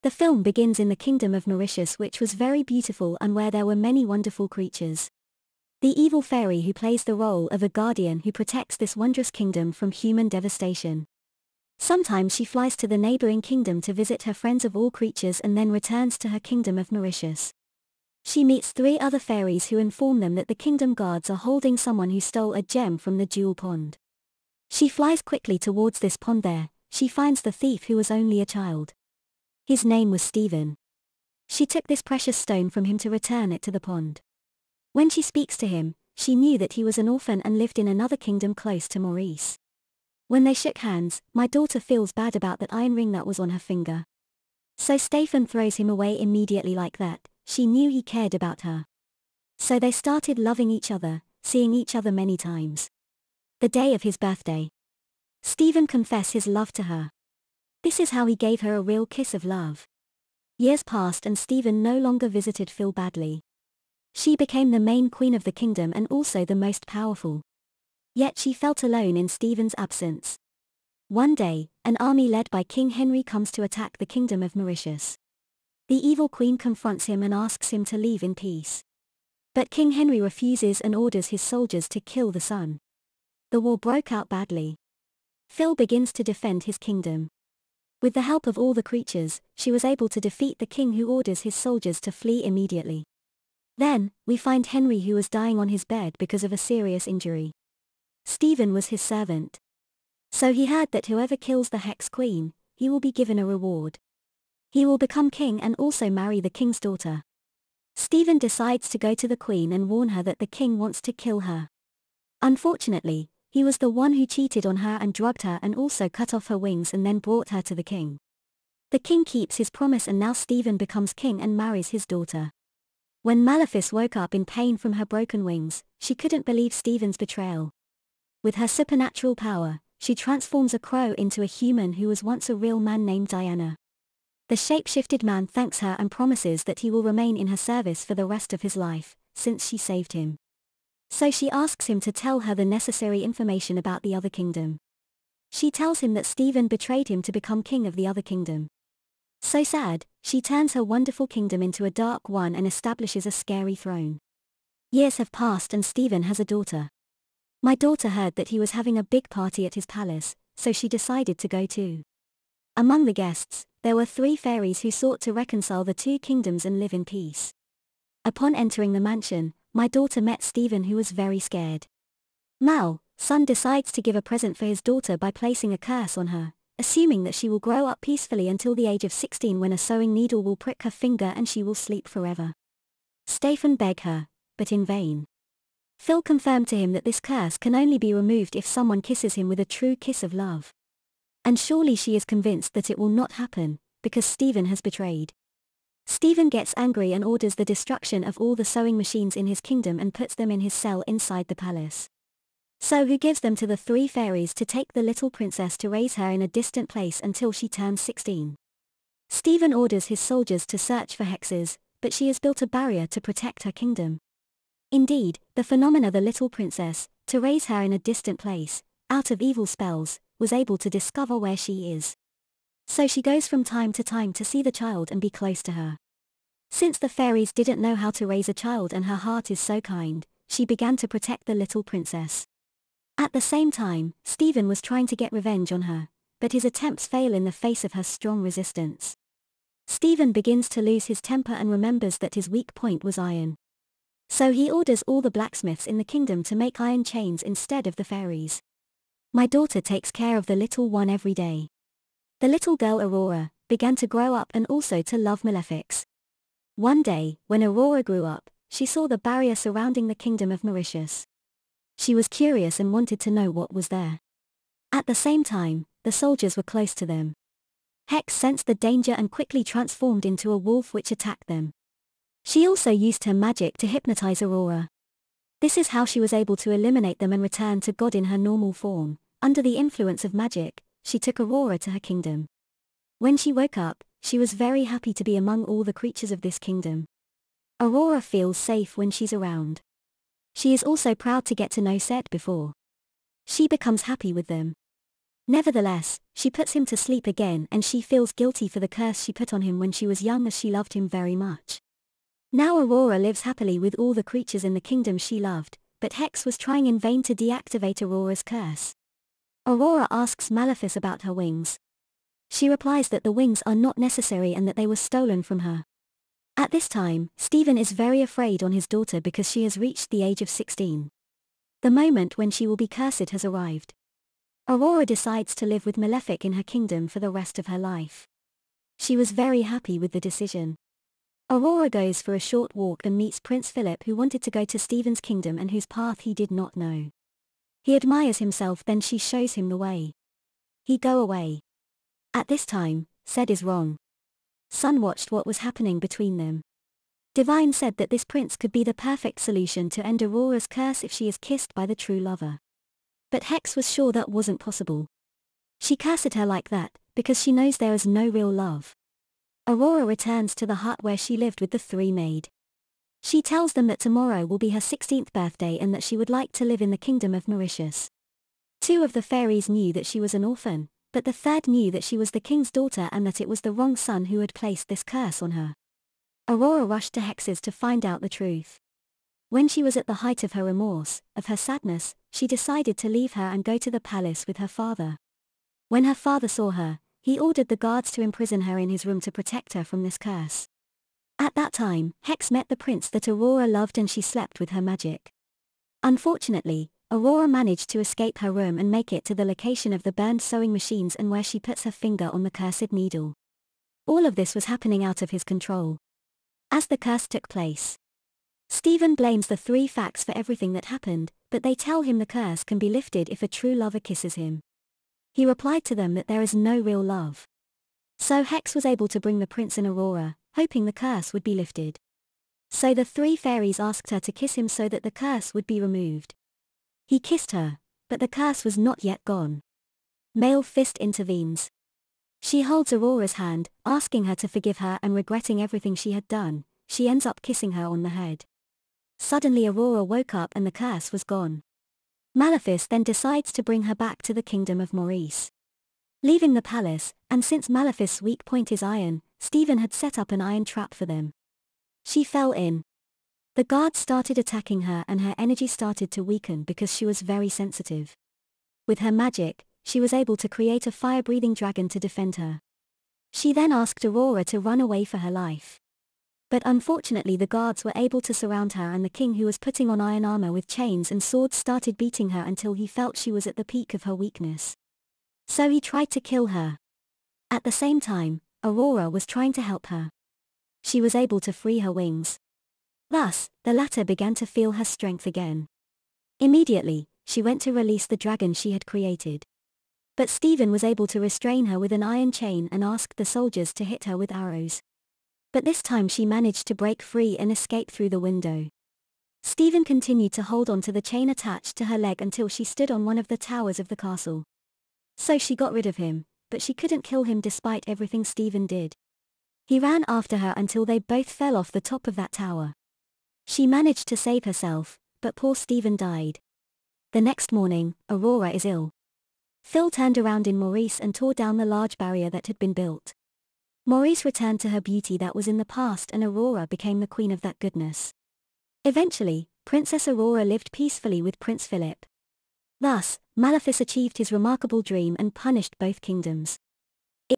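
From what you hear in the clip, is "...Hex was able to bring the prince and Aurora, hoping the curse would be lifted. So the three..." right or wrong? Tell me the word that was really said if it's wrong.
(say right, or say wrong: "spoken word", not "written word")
right.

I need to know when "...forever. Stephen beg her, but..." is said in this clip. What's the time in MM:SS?
03:02.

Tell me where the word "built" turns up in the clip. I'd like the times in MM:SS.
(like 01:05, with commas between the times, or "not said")
03:32, 08:42.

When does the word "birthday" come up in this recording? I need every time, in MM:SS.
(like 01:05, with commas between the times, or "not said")
00:54, 06:05.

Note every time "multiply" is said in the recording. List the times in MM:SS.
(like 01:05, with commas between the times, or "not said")
not said.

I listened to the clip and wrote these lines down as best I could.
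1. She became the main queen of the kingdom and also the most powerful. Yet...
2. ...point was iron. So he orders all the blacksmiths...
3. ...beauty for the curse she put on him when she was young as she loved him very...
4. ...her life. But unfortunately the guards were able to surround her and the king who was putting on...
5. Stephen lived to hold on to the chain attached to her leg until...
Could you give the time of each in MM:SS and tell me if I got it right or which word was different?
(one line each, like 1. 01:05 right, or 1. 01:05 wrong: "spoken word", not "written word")
1. 01:04 right
2. 04:02 right
3. 04:58 wrong: "guilty", not "beauty"
4. 07:45 right
5. 08:19 wrong: "continued", not "lived".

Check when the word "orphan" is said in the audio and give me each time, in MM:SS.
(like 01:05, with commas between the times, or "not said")
00:37, 06:10.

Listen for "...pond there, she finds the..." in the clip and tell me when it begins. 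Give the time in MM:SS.
00:26.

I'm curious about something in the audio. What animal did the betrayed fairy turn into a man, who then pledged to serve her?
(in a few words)
A crow.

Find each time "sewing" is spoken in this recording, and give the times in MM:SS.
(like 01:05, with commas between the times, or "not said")
02:59, 03:18, 06:40.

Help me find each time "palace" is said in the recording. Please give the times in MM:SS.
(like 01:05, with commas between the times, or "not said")
02:39, 03:21, 06:23, 07:26.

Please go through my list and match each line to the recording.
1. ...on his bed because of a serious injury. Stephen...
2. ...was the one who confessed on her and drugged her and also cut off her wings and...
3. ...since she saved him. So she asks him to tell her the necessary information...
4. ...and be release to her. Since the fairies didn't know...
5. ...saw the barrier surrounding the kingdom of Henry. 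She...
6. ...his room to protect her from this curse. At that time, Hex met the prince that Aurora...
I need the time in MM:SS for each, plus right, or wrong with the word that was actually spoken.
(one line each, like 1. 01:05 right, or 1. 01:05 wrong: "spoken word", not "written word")
1. 01:35 right
2. 01:53 wrong: "cheated", not "confessed"
3. 02:19 right
4. 03:45 wrong: "close", not "release"
5. 04:18 wrong: "Mauritius", not "Henry"
6. 06:28 right.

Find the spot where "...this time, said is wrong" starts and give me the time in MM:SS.
05:42.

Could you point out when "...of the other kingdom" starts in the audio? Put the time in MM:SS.
02:27.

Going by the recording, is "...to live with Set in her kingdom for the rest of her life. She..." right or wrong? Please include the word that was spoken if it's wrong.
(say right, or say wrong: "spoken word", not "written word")
wrong: "Malefic", not "Set".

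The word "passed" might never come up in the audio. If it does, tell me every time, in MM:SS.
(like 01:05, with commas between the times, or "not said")
01:00, 02:35.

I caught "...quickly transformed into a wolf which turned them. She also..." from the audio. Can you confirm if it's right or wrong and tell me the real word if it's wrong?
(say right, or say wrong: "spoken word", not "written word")
wrong: "attacked", not "turned".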